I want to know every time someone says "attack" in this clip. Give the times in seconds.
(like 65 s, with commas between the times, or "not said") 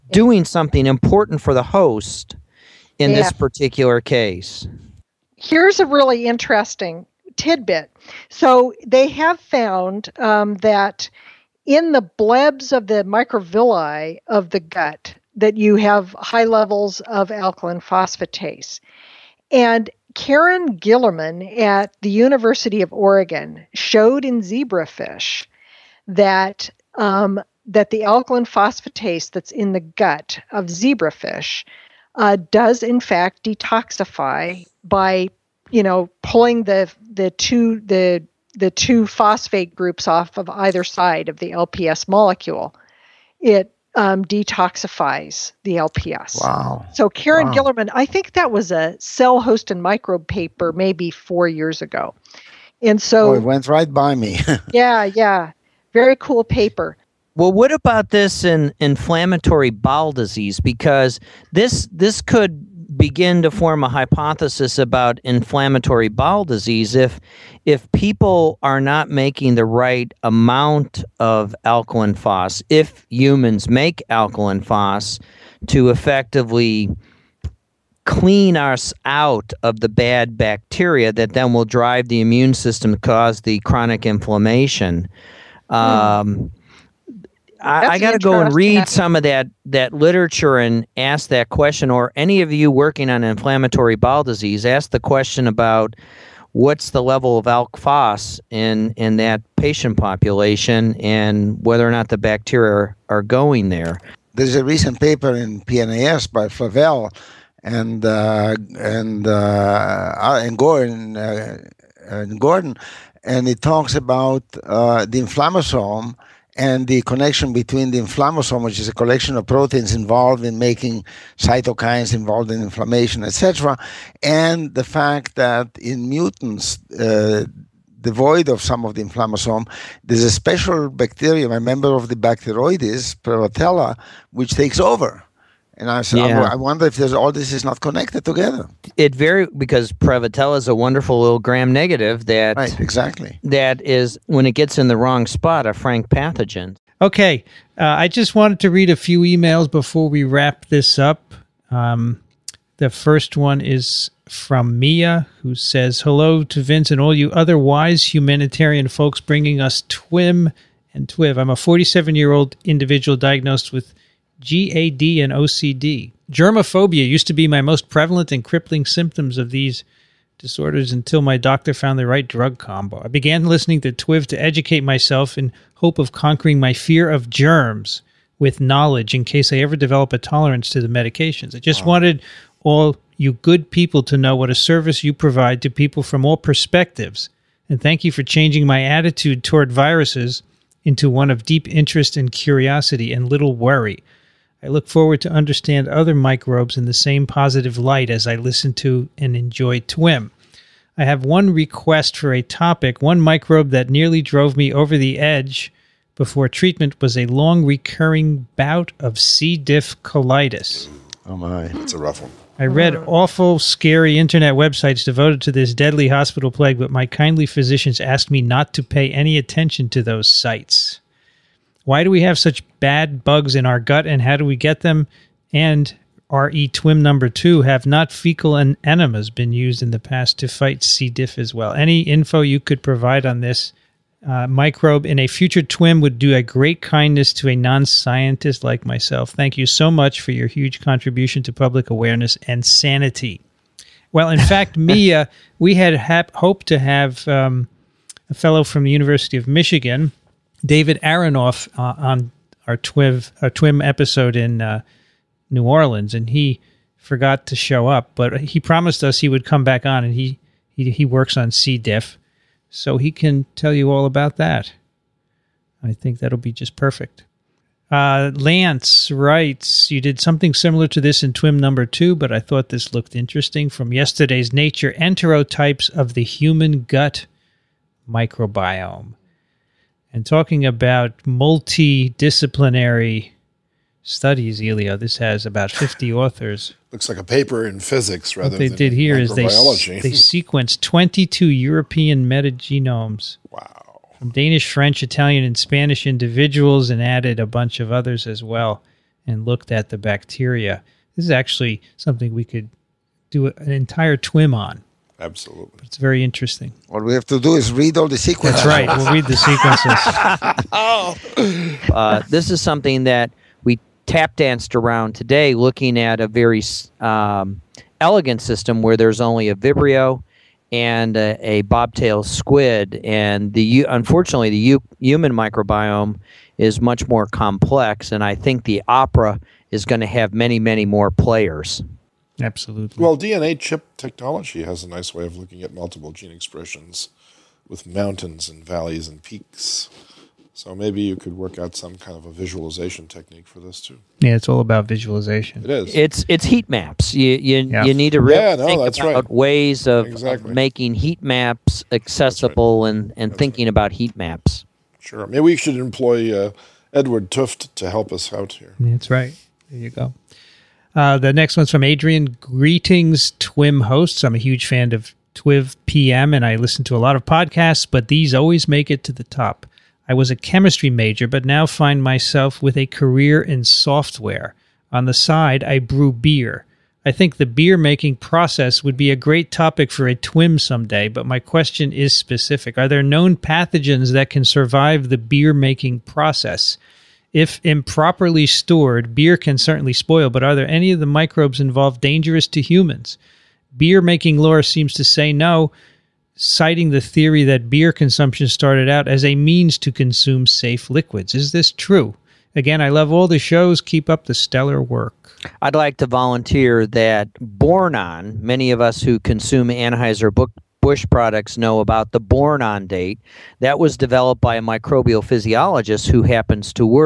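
not said.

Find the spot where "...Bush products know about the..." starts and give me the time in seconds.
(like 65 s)
410 s.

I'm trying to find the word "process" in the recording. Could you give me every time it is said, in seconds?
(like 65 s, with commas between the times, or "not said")
378 s, 386 s.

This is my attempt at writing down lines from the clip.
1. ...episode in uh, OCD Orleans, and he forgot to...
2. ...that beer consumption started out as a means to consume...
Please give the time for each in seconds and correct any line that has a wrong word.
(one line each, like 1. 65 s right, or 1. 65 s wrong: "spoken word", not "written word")
1. 253 s wrong: "New", not "OCD"
2. 397 s right.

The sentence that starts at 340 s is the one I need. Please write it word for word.
So maybe you could work out some kind of a visualization technique for this too.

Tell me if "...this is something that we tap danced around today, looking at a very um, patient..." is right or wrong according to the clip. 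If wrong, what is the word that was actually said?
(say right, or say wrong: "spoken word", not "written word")
wrong: "elegant", not "patient".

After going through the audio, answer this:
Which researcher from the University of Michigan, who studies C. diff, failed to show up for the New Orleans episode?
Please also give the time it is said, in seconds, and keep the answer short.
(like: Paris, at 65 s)
David Aronoff, at 250 s.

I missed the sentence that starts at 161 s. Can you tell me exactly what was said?
I'm a 47 year old individual diagnosed with GAD, and OCD.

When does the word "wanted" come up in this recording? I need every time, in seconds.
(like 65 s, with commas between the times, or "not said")
148 s, 181 s.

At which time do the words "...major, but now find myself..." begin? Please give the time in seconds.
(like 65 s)
370 s.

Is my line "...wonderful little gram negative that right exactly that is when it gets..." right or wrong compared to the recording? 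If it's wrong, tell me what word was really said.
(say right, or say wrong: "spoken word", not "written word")
right.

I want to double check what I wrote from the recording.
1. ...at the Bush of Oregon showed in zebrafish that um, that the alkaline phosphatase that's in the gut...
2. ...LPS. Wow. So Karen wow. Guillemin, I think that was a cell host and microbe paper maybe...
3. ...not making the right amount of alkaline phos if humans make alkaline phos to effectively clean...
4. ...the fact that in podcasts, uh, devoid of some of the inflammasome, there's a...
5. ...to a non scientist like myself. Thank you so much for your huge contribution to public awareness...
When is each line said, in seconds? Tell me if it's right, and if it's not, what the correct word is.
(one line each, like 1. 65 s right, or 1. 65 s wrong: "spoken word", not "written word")
1. 21 s wrong: "University", not "Bush"
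2. 45 s right
3. 68 s right
4. 124 s wrong: "mutants", not "podcasts"
5. 237 s right.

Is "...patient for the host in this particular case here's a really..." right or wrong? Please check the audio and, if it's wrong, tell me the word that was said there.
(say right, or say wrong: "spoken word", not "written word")
wrong: "important", not "patient".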